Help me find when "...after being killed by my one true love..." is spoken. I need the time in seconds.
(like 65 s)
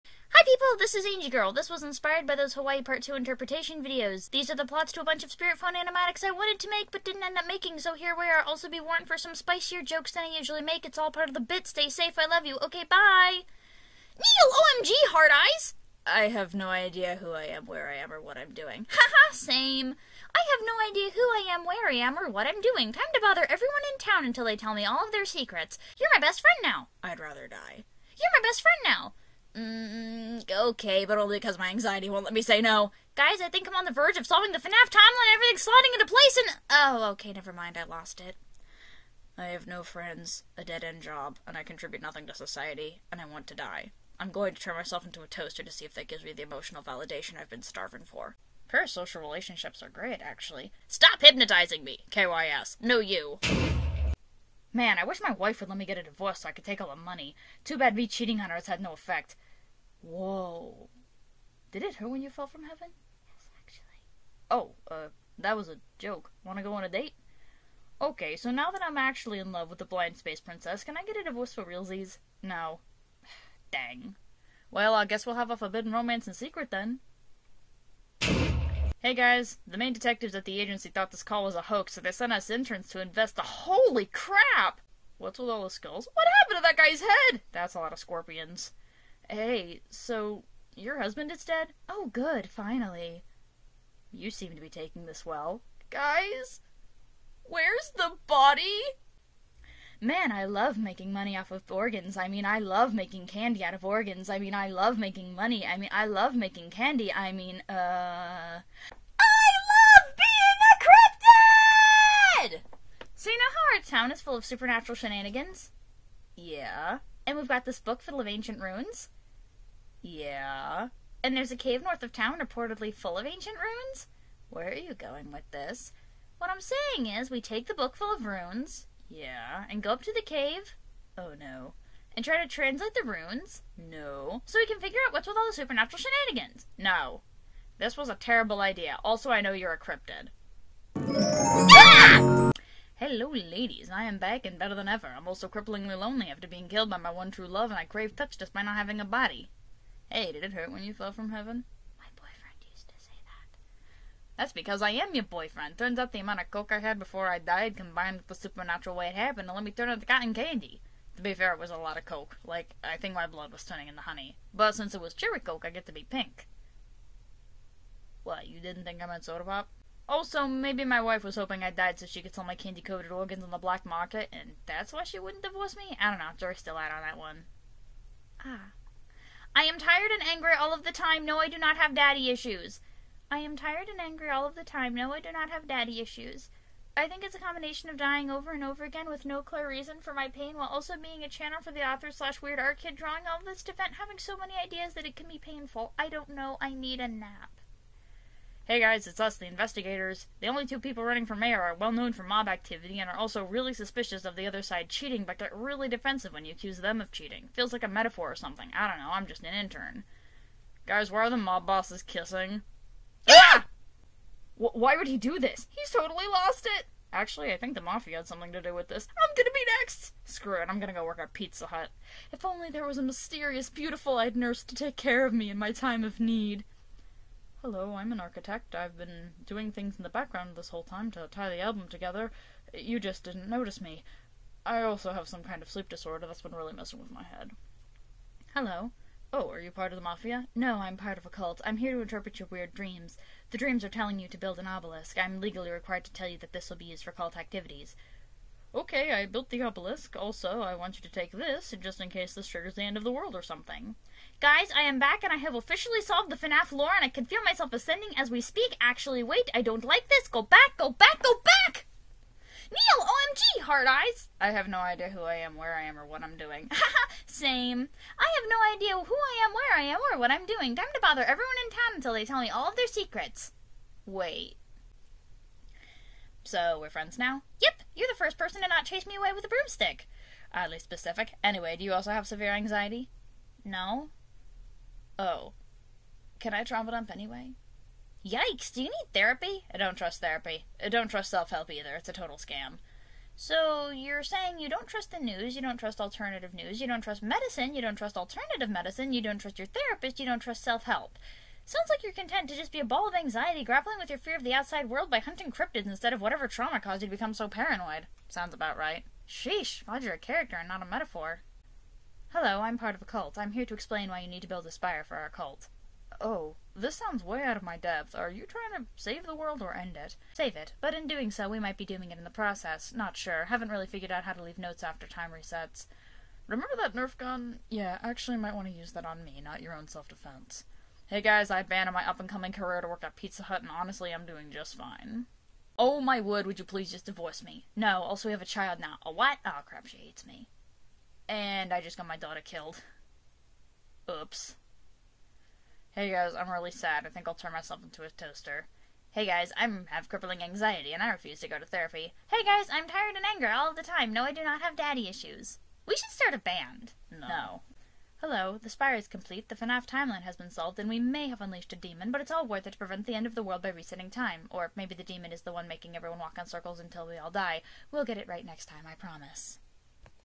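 146 s.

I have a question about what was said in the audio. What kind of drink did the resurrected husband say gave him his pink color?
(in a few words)
Cherry coke.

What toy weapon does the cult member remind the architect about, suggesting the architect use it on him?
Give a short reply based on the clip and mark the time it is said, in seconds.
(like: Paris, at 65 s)
Nerf gun, at 326 s.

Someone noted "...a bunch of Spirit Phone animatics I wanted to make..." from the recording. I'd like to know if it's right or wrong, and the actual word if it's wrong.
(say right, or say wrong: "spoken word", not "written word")
right.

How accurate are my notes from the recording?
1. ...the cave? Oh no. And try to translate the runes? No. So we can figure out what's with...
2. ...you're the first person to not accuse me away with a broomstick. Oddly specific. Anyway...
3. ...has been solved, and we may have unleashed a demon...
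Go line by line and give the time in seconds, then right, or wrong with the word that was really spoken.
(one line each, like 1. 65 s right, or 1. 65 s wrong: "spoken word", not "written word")
1. 130 s right
2. 277 s wrong: "chase", not "accuse"
3. 360 s right.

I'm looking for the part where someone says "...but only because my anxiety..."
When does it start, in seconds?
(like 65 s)
31 s.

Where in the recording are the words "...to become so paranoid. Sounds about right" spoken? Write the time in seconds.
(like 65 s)
307 s.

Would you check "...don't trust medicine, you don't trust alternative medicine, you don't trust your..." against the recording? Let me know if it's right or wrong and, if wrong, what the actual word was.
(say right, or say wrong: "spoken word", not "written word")
right.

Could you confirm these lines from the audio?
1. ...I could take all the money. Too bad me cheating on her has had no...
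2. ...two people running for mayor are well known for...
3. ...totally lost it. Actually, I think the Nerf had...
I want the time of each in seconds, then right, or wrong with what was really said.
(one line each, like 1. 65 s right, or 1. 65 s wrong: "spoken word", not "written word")
1. 56 s right
2. 200 s right
3. 215 s wrong: "Mafia", not "Nerf".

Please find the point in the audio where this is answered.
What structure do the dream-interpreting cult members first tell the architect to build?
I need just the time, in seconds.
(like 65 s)
244 s.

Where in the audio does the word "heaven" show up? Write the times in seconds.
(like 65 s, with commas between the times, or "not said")
62 s, 151 s.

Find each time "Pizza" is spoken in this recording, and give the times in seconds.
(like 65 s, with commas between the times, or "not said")
221 s, 333 s.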